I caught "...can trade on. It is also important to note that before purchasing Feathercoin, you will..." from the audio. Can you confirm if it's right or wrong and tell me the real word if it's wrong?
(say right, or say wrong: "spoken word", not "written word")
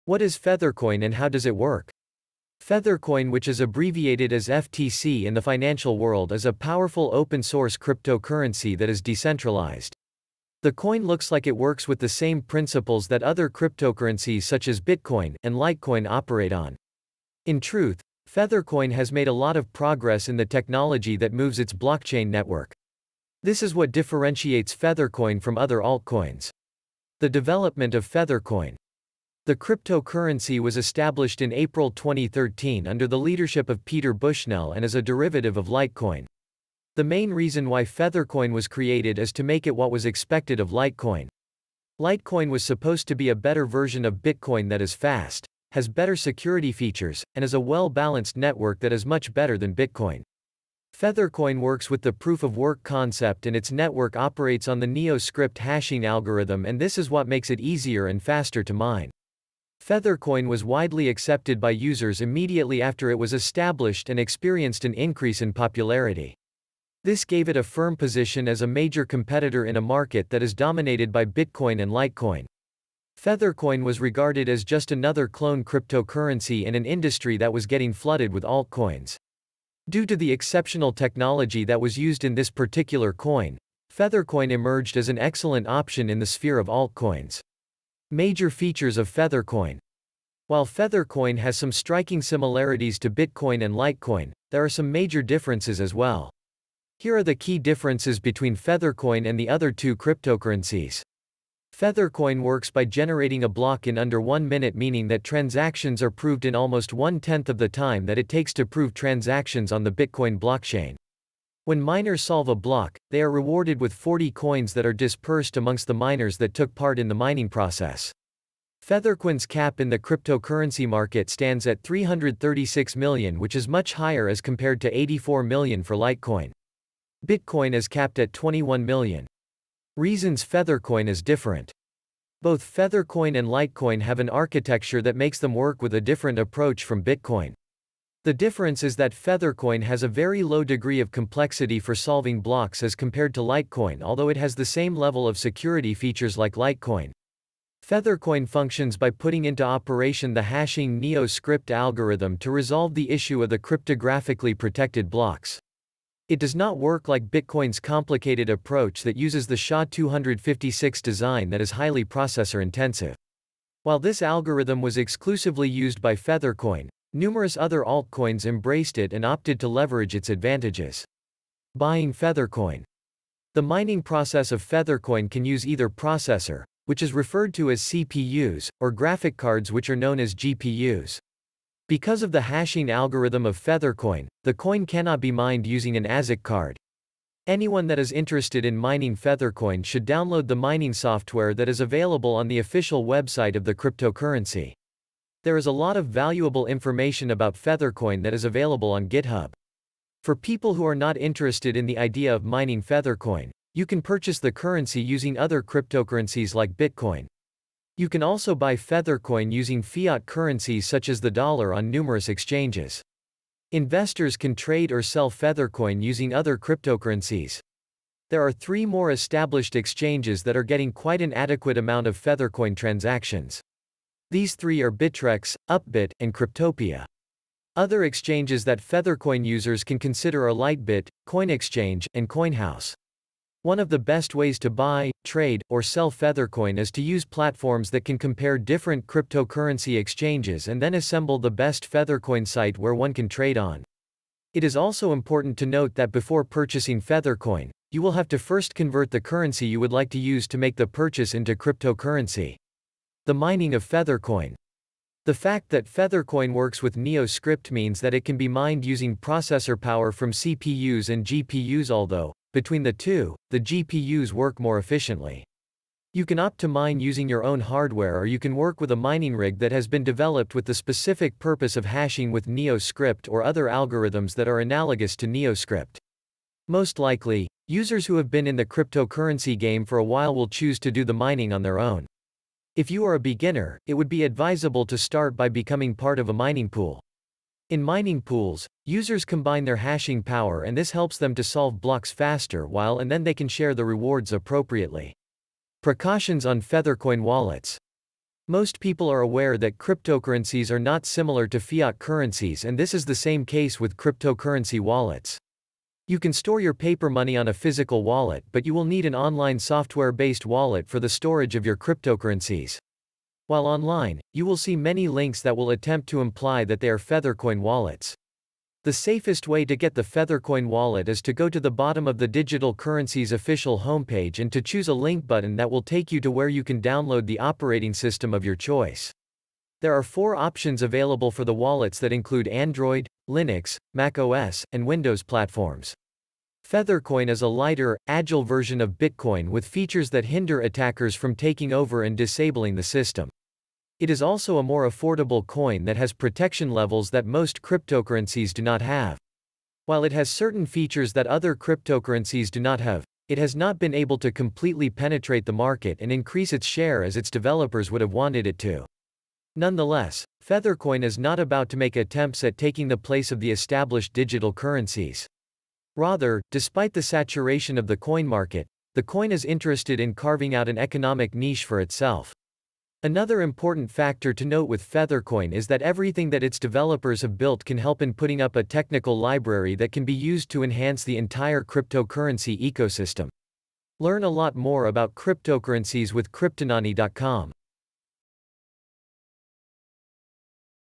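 right.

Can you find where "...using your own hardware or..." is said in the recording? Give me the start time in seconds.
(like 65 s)
266 s.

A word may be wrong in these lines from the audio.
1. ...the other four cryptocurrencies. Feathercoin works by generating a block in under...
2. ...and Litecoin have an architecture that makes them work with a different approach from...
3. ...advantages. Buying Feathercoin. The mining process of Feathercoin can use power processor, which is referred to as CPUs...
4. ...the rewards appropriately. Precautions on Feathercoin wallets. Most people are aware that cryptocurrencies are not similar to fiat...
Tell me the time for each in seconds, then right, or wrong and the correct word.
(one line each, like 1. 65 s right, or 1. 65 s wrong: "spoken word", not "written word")
1. 99 s wrong: "two", not "four"
2. 133 s right
3. 170 s wrong: "either", not "power"
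4. 293 s right.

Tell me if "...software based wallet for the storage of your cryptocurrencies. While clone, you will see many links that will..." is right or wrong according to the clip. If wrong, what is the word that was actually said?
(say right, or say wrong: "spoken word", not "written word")
wrong: "online", not "clone".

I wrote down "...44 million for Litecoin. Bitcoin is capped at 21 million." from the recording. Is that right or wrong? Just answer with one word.
wrong.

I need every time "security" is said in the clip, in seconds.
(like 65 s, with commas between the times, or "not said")
46 s, 145 s.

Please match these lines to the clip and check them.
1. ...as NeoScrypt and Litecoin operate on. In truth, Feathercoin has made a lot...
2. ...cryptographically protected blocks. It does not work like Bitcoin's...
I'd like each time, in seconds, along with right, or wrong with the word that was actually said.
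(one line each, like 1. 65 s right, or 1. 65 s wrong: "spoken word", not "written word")
1. 14 s wrong: "Bitcoin", not "NeoScrypt"
2. 153 s right.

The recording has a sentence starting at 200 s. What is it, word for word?
For people who are not interested in the idea of mining Feathercoin, you can purchase the currency using other cryptocurrencies like Bitcoin.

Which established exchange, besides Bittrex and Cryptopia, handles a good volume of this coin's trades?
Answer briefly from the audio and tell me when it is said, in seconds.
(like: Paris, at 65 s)
Upbit, at 225 s.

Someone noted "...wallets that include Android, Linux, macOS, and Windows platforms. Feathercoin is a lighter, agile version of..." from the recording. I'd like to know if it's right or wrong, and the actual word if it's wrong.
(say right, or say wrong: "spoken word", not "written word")
right.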